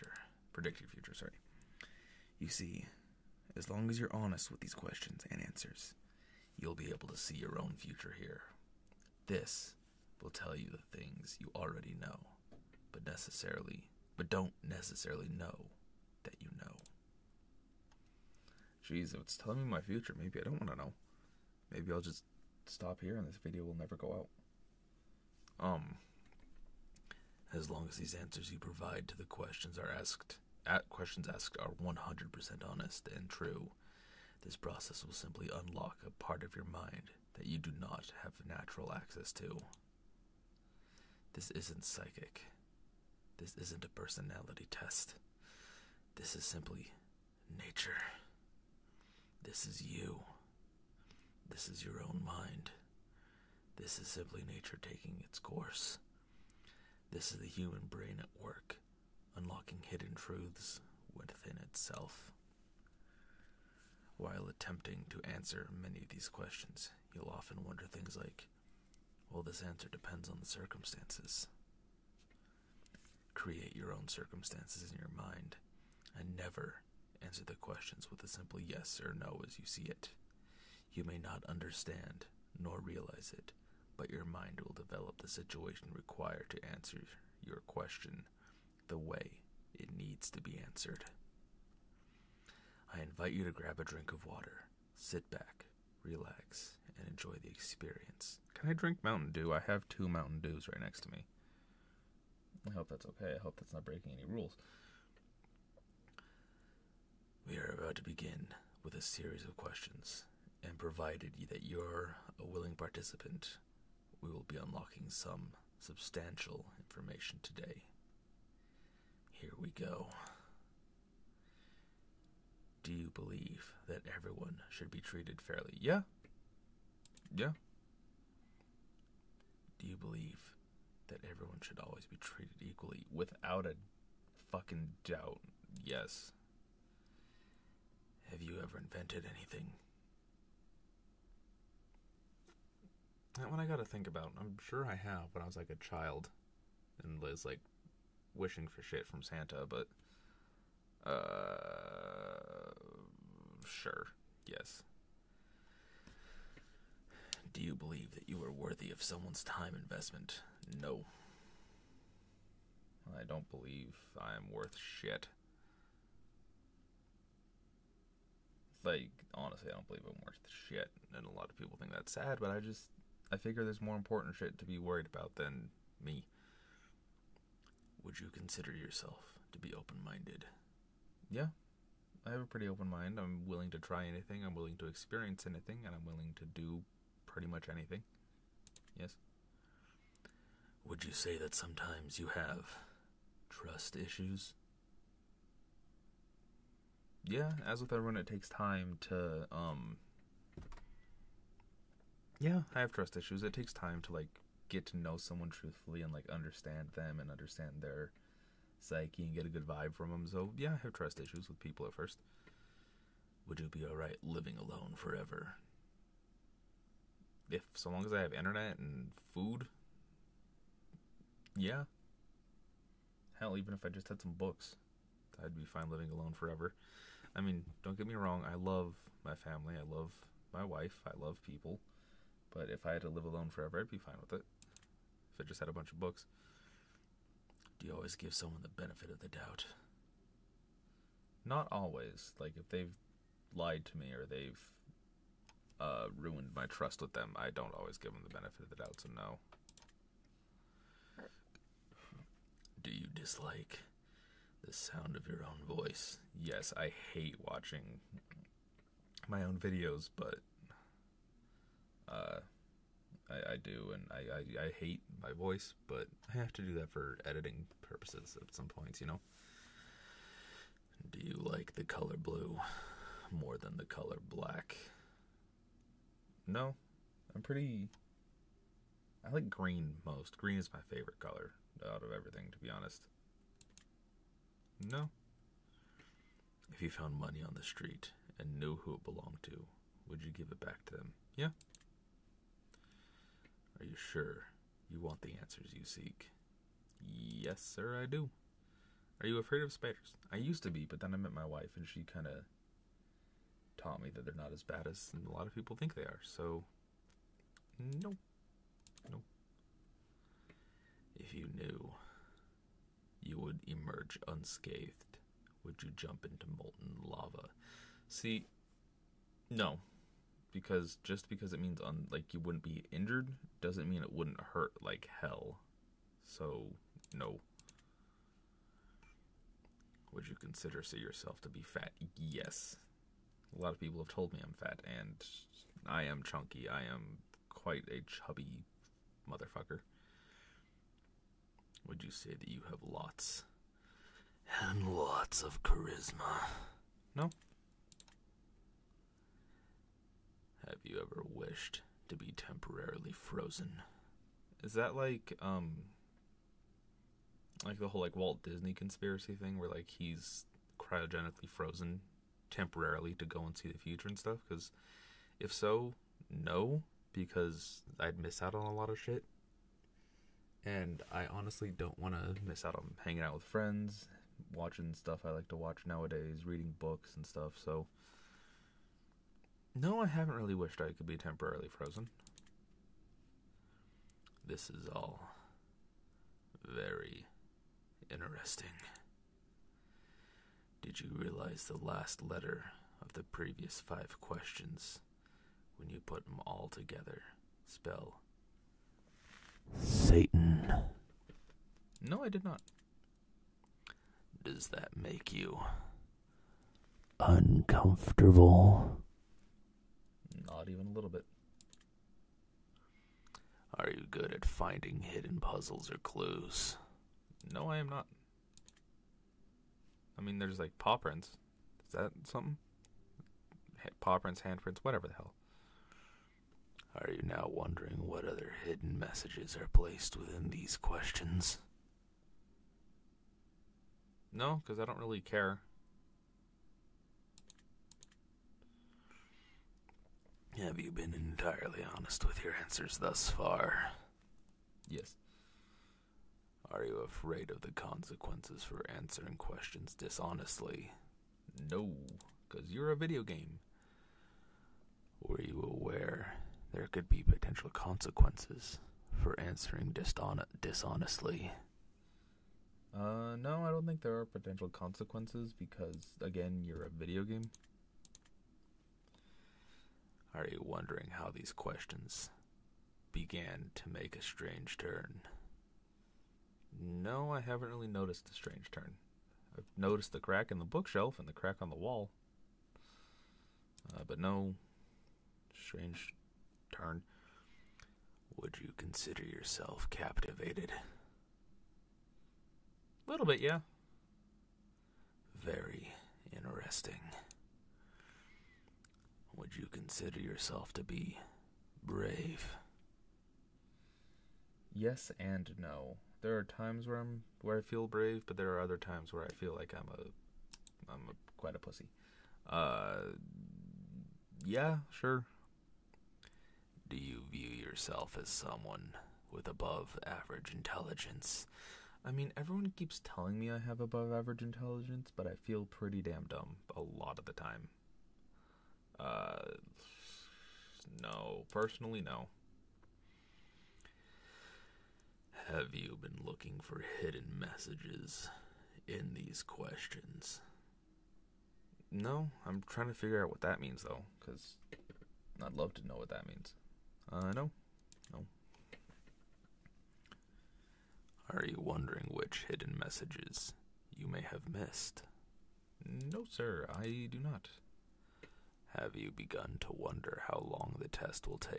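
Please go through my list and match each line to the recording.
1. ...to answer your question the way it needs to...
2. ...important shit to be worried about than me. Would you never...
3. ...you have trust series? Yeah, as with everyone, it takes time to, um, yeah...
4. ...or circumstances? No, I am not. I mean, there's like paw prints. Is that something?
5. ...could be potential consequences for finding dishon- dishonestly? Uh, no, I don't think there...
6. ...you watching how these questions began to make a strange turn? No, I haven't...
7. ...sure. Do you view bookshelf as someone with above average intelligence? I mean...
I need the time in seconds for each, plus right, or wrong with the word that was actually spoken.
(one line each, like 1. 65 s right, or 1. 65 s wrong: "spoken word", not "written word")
1. 86 s right
2. 173 s wrong: "consider", not "never"
3. 192 s wrong: "issues", not "series"
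4. 415 s wrong: "clues", not "circumstances"
5. 456 s wrong: "answering", not "finding"
6. 470 s wrong: "wondering", not "watching"
7. 514 s wrong: "yourself", not "bookshelf".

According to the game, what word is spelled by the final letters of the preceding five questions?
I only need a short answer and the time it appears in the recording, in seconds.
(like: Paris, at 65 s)
Satan, at 399 s.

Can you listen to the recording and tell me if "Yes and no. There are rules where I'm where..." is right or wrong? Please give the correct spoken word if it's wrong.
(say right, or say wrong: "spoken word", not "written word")
wrong: "times", not "rules".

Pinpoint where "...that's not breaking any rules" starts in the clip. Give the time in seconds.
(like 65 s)
103 s.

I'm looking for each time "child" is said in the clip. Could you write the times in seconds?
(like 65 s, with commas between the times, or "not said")
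145 s.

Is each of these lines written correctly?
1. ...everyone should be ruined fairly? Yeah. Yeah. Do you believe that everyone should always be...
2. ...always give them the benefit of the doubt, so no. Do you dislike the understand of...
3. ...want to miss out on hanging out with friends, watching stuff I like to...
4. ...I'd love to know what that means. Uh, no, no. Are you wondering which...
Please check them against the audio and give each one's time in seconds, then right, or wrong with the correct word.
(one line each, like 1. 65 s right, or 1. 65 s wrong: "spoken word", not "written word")
1. 124 s wrong: "treated", not "ruined"
2. 247 s wrong: "sound", not "understand"
3. 371 s right
4. 545 s right.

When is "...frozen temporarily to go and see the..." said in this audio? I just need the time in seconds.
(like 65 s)
361 s.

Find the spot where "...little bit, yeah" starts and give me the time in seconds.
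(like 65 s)
493 s.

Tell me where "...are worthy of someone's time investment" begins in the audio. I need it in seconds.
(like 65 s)
158 s.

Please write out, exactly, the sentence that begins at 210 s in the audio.
So yeah, I have trust issues with people at first.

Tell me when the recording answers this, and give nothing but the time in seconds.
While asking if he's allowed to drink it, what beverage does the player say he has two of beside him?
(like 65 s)
100 s.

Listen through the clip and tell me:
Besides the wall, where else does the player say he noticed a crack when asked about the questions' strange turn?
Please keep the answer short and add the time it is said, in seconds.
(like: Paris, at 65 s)
The bookshelf, at 480 s.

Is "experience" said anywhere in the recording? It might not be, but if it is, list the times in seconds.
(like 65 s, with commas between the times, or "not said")
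97 s, 184 s.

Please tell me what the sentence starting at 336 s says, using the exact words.
I am quite a chubby motherfucker.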